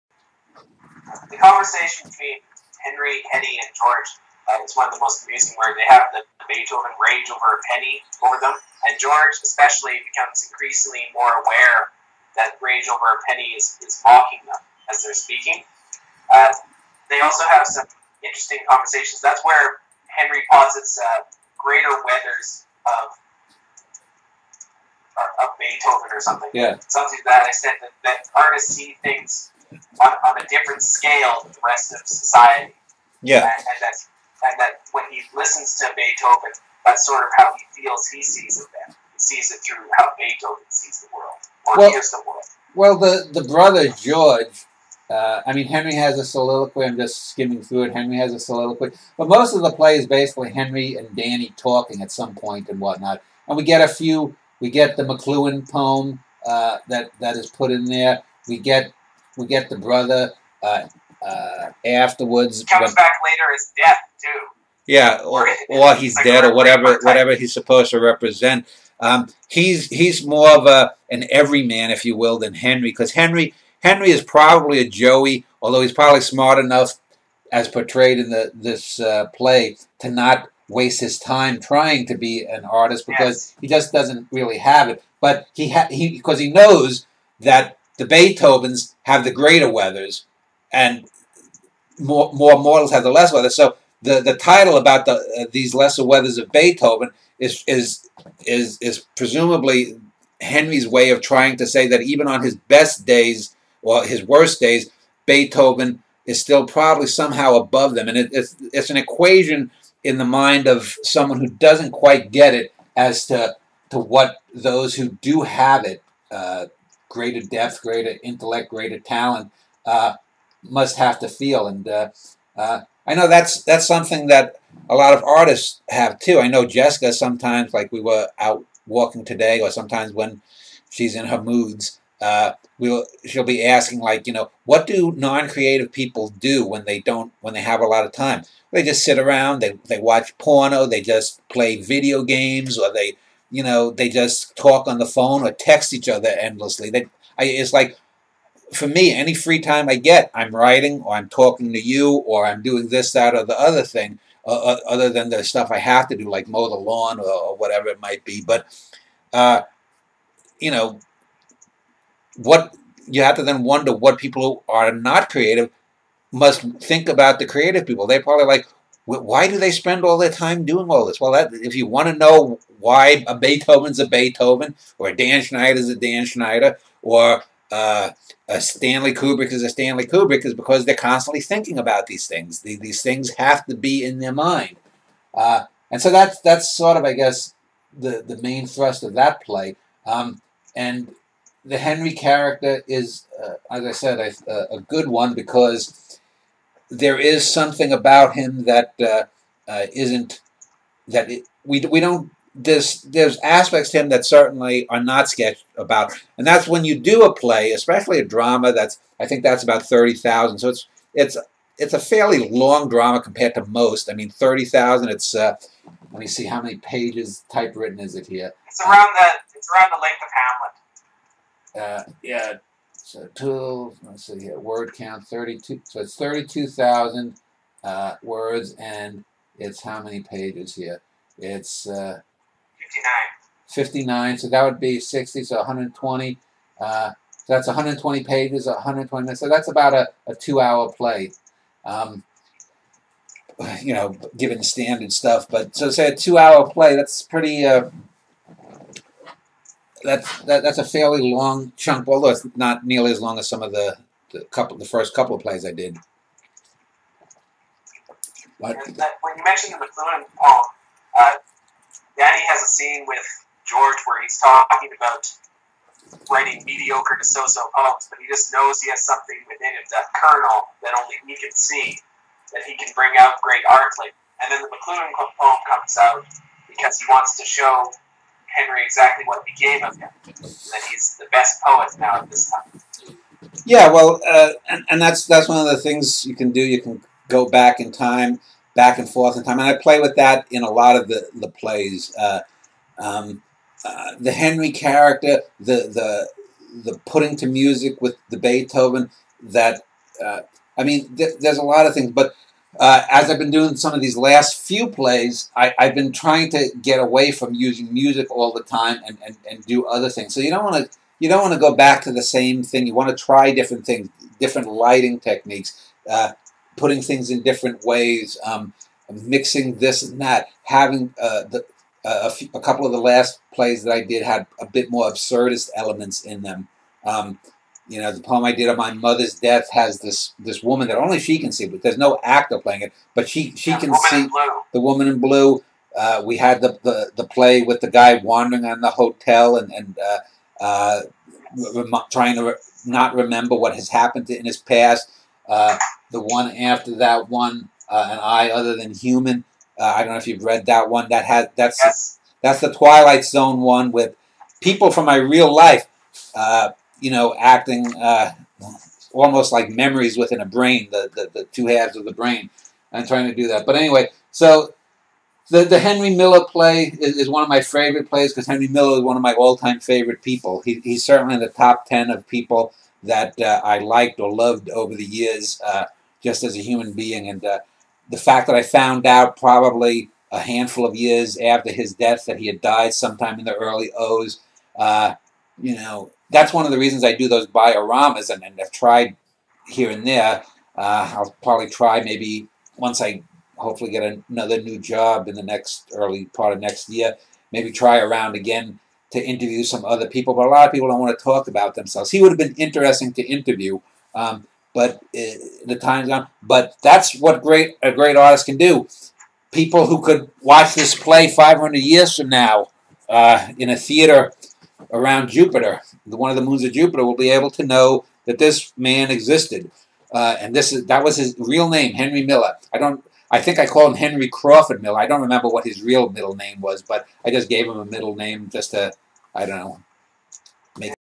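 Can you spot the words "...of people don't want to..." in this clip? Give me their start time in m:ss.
6:40.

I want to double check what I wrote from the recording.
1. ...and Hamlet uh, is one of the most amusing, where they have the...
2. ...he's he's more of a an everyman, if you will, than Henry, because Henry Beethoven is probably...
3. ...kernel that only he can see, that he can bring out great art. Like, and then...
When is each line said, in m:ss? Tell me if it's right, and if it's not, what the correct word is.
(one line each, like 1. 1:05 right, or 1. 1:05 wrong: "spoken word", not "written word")
1. 0:03 wrong: "George", not "Hamlet"
2. 1:09 wrong: "Henry", not "Beethoven"
3. 4:30 right.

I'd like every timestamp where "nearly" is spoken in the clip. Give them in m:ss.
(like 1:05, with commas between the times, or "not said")
4:12.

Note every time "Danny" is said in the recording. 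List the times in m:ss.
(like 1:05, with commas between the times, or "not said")
0:51, 4:22.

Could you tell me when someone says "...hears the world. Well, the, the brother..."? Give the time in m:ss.
0:41.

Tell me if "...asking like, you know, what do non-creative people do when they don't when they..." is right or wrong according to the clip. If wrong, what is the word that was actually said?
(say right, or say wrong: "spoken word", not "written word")
right.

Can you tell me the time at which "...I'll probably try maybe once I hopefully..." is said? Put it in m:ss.
6:31.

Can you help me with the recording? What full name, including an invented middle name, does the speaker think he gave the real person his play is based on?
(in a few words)
Henry Crawford Miller.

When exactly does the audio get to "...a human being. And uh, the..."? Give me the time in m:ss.
6:16.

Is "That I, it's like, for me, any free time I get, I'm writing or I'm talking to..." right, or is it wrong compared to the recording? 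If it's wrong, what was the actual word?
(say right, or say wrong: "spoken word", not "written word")
right.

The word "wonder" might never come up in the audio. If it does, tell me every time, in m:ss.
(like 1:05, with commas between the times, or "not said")
2:43.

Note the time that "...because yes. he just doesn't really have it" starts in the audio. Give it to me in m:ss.
1:23.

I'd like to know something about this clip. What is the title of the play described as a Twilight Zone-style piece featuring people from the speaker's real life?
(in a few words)
An Eye Other Than Human.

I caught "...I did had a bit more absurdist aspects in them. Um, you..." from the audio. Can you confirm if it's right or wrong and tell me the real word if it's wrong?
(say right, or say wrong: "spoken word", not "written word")
wrong: "elements", not "aspects".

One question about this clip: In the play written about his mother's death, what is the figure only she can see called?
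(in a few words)
the woman in blue.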